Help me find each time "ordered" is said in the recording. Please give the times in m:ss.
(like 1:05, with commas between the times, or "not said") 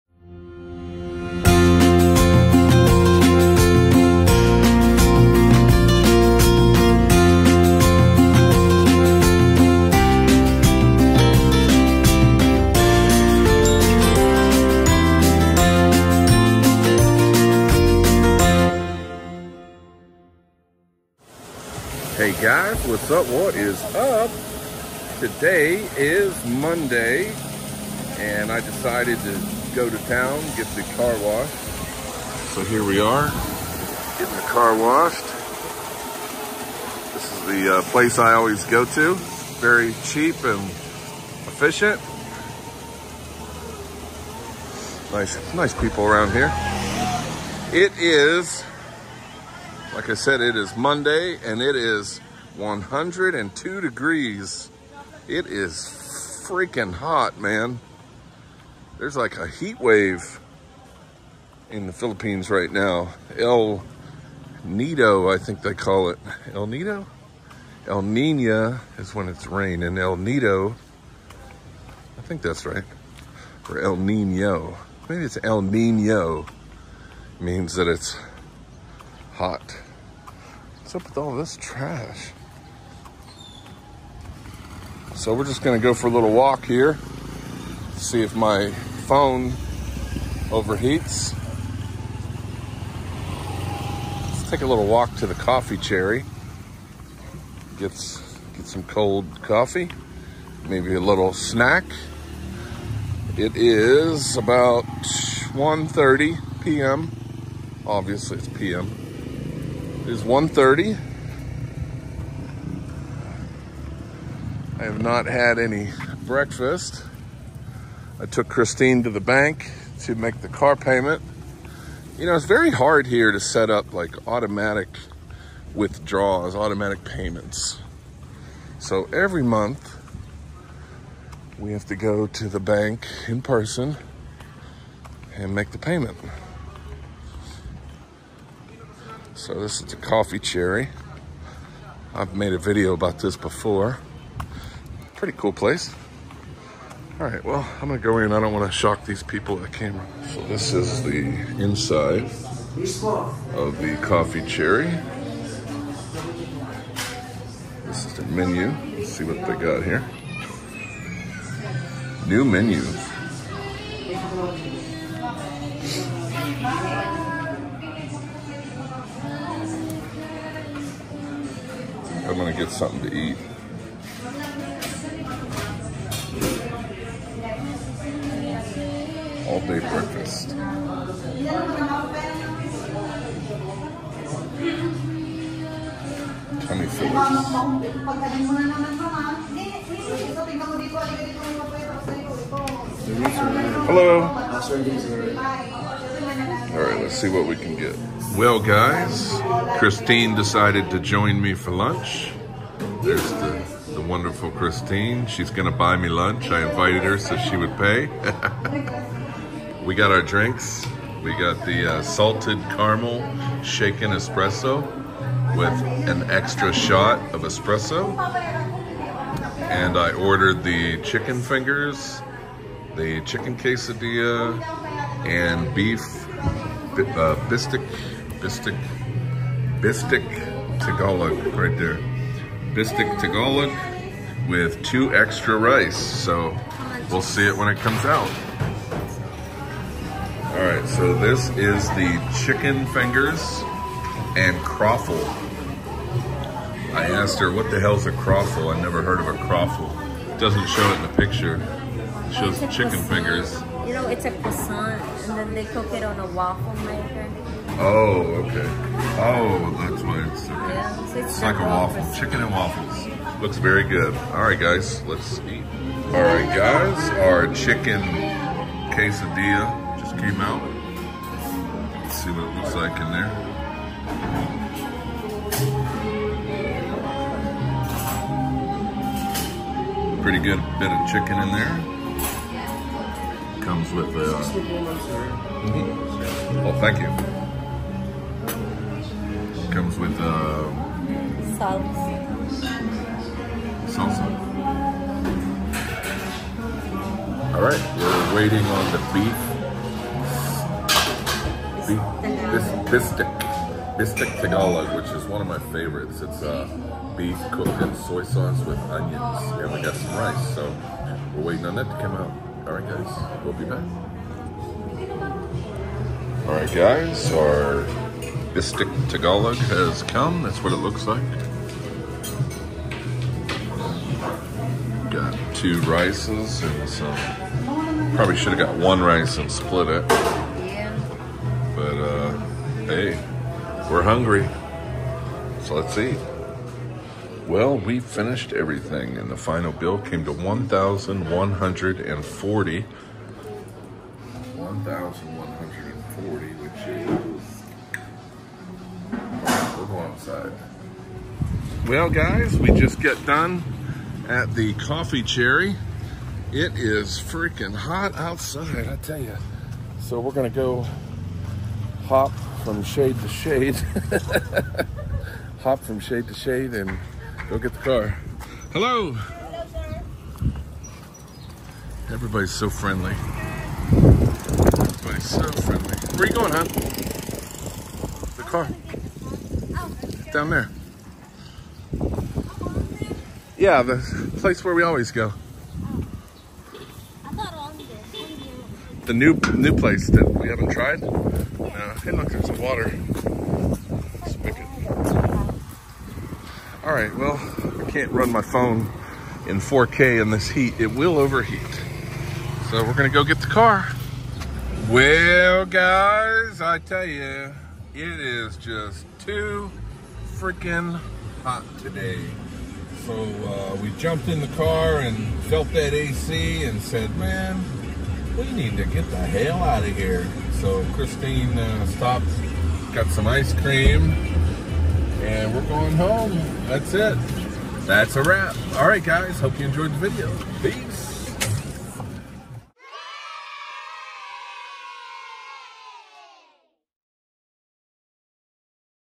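3:40.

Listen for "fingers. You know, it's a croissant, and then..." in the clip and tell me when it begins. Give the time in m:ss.
4:13.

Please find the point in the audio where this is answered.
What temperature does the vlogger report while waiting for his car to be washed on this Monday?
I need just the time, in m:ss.
0:52.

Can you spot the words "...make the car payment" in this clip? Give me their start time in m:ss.
2:00.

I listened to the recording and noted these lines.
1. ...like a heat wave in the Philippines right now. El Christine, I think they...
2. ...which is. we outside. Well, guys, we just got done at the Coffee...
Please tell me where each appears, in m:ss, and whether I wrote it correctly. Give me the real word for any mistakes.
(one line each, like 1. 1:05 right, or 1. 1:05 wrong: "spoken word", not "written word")
1. 0:59 wrong: "Nido", not "Christine"
2. 5:46 right.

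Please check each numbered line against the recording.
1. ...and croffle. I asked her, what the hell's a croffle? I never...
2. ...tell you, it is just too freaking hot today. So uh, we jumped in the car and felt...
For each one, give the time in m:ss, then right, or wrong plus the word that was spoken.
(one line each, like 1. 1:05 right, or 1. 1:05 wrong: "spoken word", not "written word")
1. 4:04 right
2. 6:46 right.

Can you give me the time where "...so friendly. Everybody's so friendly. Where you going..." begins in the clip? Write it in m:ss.
6:12.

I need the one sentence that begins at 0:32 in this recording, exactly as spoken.
So here we are, getting the car washed.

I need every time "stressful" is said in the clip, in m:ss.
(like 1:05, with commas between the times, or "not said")
not said.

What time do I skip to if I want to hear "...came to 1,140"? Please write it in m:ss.
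5:39.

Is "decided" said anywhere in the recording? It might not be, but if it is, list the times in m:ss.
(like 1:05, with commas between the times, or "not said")
0:28, 3:20.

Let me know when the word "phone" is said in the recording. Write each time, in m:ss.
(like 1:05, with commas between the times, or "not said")
1:28, 6:38.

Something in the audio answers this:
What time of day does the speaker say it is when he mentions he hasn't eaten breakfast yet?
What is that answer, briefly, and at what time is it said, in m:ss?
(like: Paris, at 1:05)
1:30 p.m., at 1:44.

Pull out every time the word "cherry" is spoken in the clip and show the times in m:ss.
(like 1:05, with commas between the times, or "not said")
1:35, 2:20, 2:34, 5:55.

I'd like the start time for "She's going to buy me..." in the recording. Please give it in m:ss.
3:25.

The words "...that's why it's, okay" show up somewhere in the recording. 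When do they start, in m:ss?
4:19.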